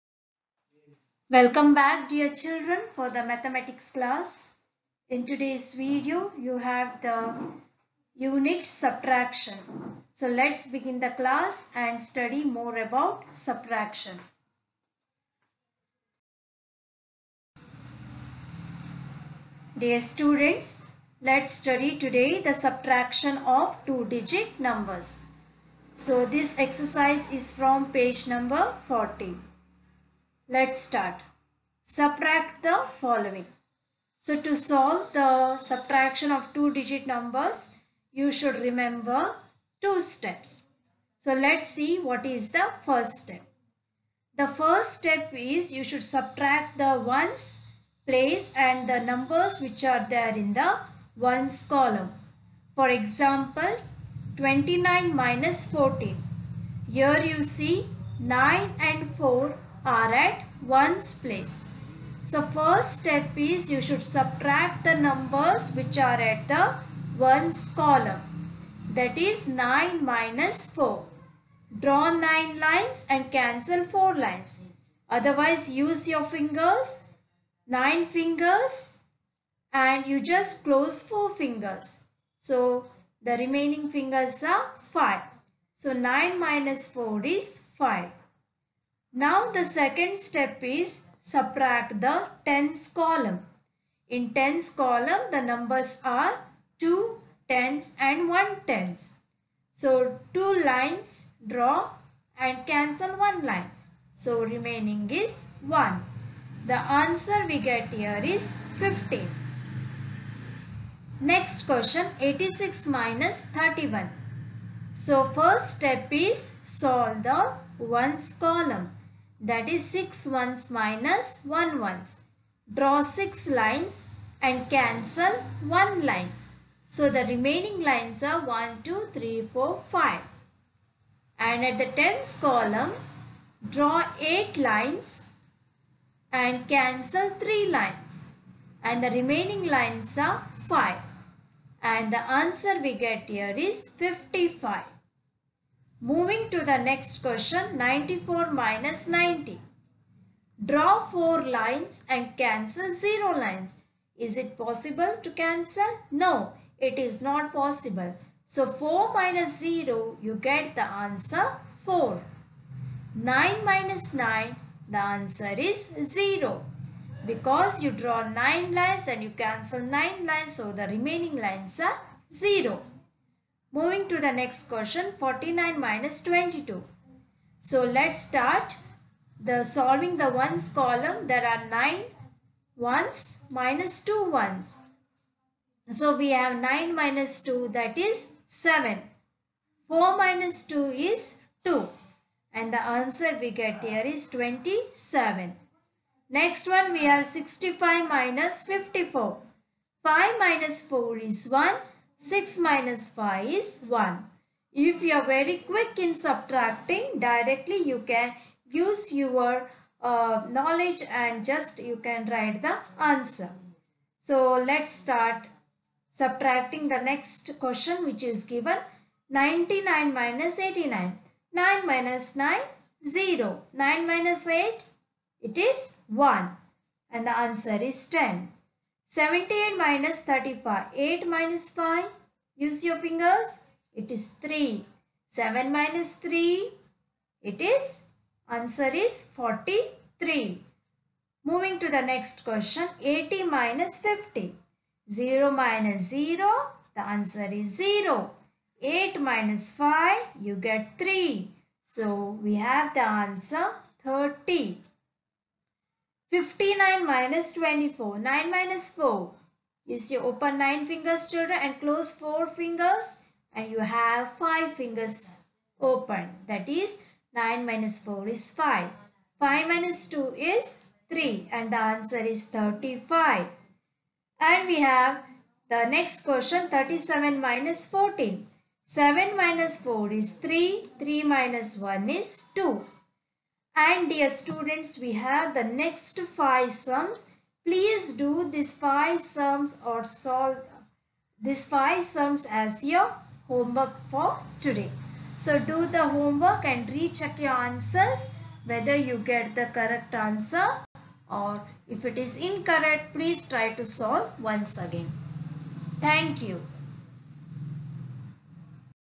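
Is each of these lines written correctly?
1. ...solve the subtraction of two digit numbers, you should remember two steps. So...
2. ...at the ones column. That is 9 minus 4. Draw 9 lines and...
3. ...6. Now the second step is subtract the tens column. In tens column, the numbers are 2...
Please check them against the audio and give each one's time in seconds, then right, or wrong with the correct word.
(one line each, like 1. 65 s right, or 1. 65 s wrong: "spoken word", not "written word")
1. 34 s right
2. 66 s right
3. 87 s wrong: "5", not "6".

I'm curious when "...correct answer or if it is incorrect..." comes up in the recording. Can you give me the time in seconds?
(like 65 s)
299 s.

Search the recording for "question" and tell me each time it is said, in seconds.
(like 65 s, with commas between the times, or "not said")
111 s, 147 s, 174 s, 217 s, 242 s, 276 s.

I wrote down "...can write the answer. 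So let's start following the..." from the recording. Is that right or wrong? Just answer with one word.
wrong.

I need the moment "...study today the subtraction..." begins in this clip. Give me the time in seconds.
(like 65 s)
21 s.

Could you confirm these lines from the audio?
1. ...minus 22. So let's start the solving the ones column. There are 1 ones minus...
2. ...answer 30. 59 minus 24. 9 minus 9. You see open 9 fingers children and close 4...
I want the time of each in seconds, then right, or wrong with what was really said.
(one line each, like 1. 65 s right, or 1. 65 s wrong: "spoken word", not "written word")
1. 175 s wrong: "9", not "1"
2. 253 s wrong: "4", not "9".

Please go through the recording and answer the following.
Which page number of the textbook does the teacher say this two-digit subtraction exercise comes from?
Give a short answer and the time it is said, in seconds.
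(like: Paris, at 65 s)
40, at 27 s.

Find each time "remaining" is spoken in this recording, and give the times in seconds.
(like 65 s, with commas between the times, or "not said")
83 s, 104 s, 127 s, 139 s, 170 s.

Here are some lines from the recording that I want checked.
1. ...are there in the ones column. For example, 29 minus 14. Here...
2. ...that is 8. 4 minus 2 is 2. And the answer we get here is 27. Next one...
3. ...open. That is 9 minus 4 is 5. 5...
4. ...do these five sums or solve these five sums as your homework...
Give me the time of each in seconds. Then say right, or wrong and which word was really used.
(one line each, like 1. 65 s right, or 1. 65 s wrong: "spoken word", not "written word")
1. 49 s right
2. 187 s wrong: "7", not "8"
3. 265 s right
4. 288 s right.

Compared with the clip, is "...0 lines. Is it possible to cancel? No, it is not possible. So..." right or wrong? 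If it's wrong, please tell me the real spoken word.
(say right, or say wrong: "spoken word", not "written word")
right.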